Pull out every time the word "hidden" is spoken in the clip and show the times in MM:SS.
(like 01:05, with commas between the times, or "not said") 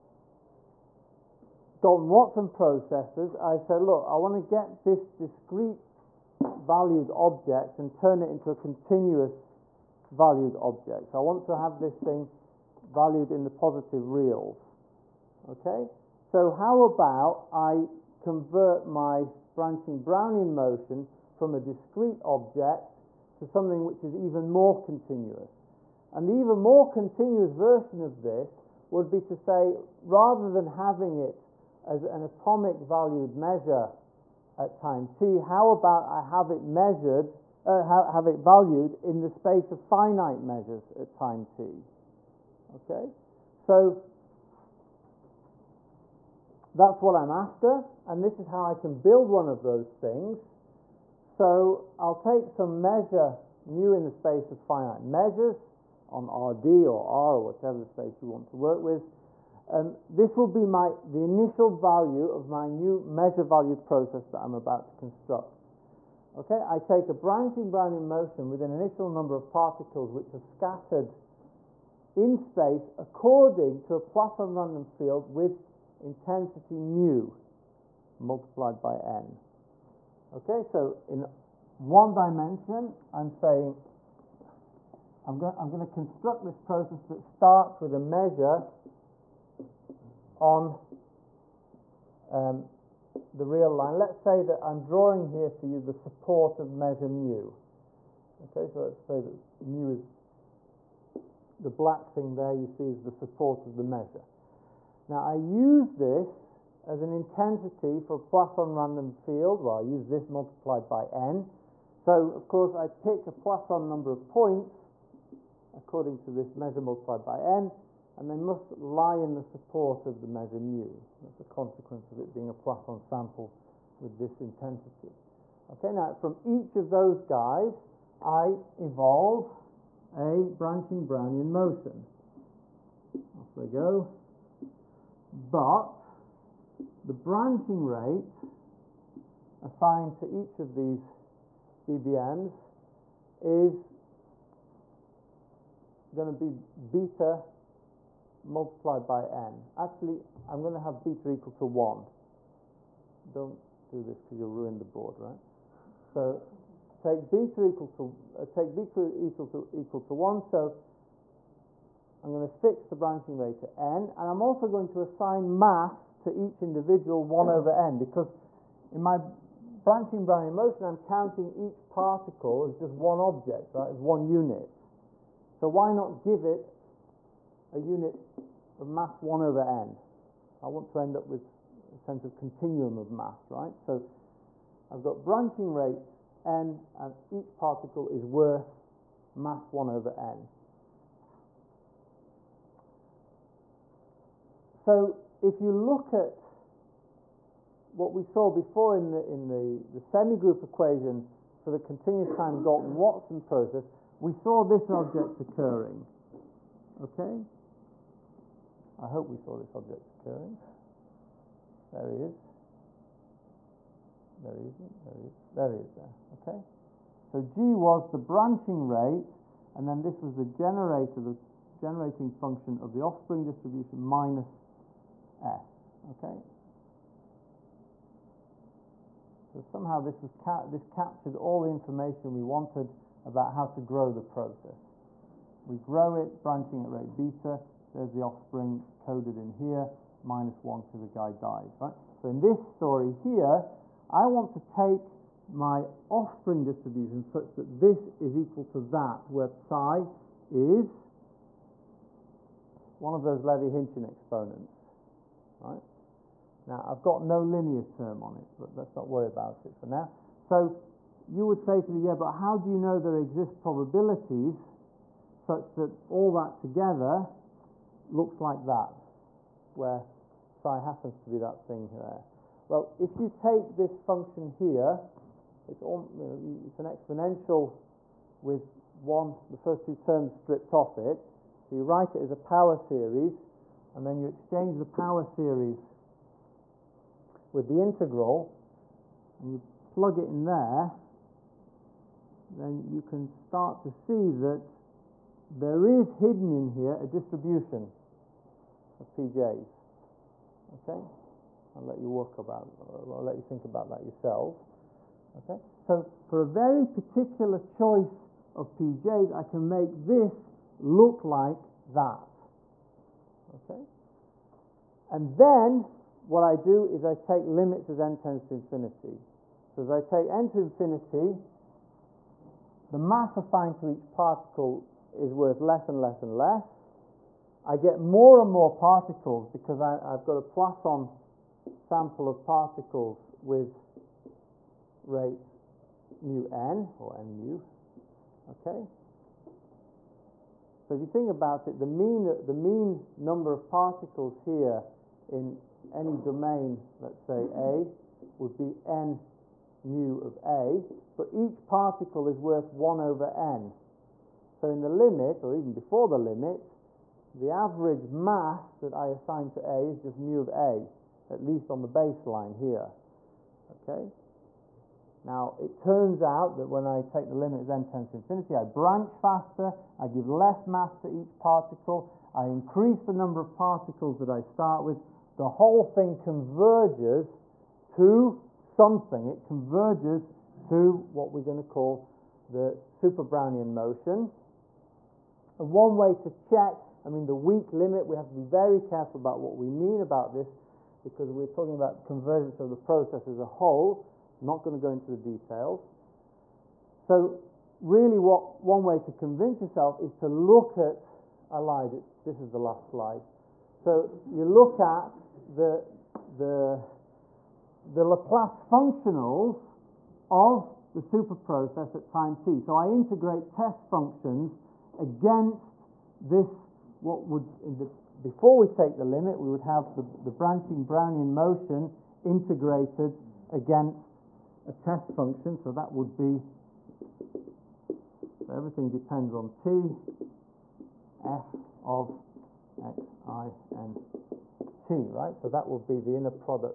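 04:56.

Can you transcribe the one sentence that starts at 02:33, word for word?
Don't do this because you'll ruin the board, right?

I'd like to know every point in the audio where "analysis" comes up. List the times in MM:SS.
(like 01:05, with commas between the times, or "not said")
not said.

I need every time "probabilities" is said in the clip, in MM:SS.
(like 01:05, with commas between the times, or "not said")
04:23.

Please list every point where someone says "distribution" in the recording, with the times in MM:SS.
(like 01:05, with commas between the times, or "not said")
03:43, 04:06, 04:57.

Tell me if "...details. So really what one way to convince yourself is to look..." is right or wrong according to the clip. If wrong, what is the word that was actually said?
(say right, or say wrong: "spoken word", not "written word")
right.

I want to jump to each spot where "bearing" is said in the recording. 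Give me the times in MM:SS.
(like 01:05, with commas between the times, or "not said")
not said.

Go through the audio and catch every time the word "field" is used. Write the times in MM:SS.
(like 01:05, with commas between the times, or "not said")
01:14, 01:49.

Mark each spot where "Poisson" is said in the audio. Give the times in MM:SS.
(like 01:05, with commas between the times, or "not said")
01:13, 01:48, 01:53, 02:02, 05:30.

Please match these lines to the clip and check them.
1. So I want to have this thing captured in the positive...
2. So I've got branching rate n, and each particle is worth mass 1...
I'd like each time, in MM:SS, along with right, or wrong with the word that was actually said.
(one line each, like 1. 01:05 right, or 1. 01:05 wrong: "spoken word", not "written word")
1. 00:11 wrong: "valued", not "captured"
2. 03:03 right.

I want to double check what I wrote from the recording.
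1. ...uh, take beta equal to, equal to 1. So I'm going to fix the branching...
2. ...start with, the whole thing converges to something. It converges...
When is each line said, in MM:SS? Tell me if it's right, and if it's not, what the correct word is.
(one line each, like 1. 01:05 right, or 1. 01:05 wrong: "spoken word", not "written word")
1. 02:38 right
2. 06:14 right.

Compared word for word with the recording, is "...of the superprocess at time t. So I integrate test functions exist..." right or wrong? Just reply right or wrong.
wrong.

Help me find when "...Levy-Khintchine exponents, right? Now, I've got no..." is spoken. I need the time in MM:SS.
04:13.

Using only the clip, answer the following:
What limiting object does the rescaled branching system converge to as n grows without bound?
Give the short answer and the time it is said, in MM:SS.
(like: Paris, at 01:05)
super Brownian motion, at 06:22.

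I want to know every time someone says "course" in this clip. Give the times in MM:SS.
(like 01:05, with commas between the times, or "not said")
01:52.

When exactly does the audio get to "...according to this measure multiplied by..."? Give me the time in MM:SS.
01:55.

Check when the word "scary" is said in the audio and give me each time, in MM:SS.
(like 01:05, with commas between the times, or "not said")
not said.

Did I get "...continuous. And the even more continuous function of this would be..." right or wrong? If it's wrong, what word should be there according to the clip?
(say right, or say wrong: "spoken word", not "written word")
wrong: "version", not "function".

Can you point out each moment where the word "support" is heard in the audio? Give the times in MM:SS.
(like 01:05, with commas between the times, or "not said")
01:35, 01:43, 01:59.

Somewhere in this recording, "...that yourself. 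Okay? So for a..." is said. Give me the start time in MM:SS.
05:03.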